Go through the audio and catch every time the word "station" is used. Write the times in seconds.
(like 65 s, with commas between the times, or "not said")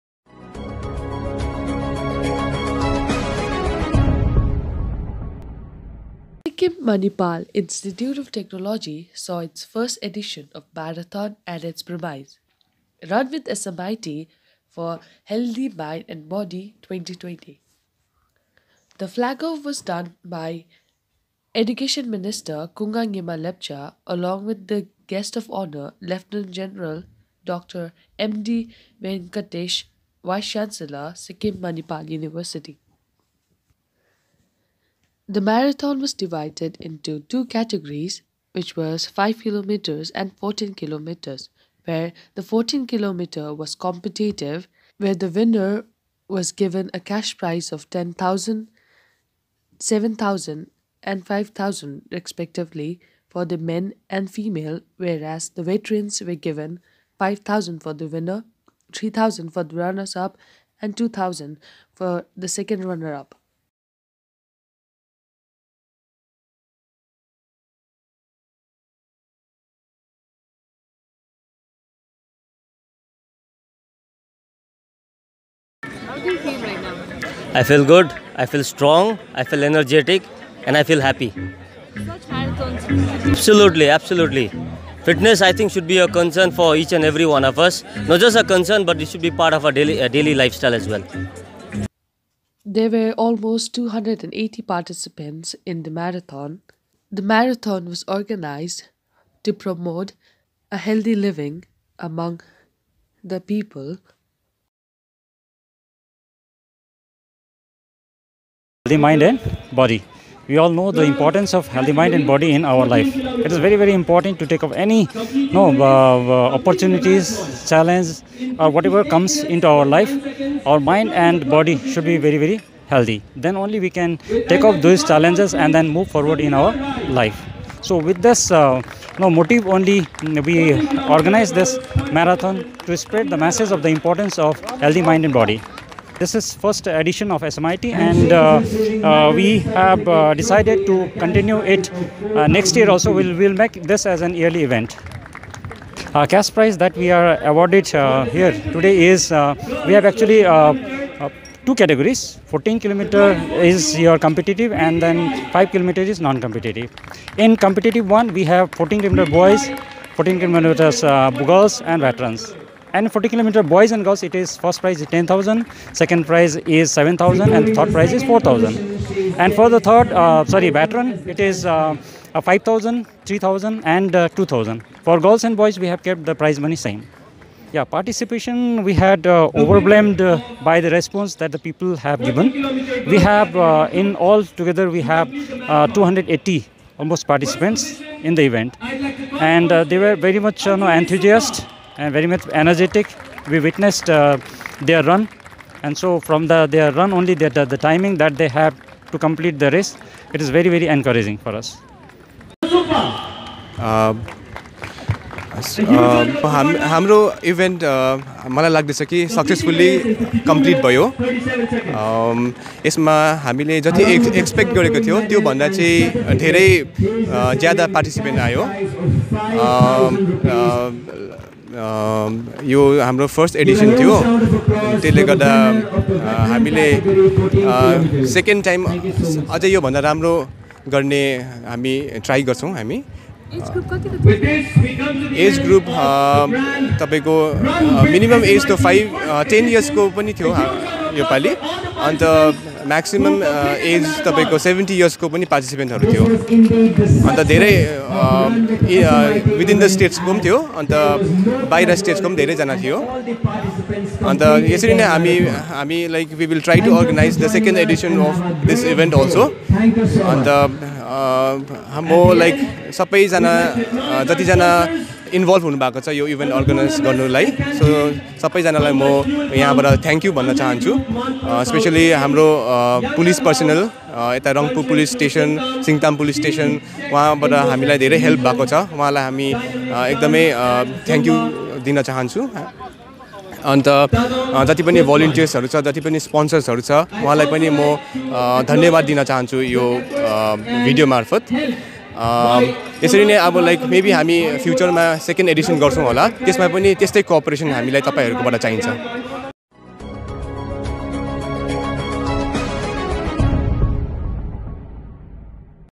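not said.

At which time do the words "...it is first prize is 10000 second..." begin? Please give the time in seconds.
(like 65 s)
164 s.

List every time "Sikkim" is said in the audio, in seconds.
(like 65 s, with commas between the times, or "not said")
6 s, 31 s.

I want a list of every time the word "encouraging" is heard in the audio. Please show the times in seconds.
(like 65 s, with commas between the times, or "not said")
200 s.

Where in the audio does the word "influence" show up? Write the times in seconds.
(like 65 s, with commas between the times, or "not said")
not said.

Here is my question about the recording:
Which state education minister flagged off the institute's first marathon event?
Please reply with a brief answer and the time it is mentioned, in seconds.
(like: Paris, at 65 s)
Kunga Nyima Lepcha, at 22 s.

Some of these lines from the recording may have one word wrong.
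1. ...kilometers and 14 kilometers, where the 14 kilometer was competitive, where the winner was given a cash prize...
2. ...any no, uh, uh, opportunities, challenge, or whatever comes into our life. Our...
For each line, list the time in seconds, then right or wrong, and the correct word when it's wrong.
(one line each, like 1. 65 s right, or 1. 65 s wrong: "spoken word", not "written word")
1. 39 s right
2. 114 s right.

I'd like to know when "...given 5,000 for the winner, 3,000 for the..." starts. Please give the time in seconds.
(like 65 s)
56 s.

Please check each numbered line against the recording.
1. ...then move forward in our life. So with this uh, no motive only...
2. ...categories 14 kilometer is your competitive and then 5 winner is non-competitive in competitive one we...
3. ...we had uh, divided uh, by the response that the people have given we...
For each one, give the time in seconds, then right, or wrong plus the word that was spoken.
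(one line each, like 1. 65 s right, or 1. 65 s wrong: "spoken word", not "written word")
1. 125 s right
2. 151 s wrong: "kilometer", not "winner"
3. 178 s wrong: "overwhelmed", not "divided".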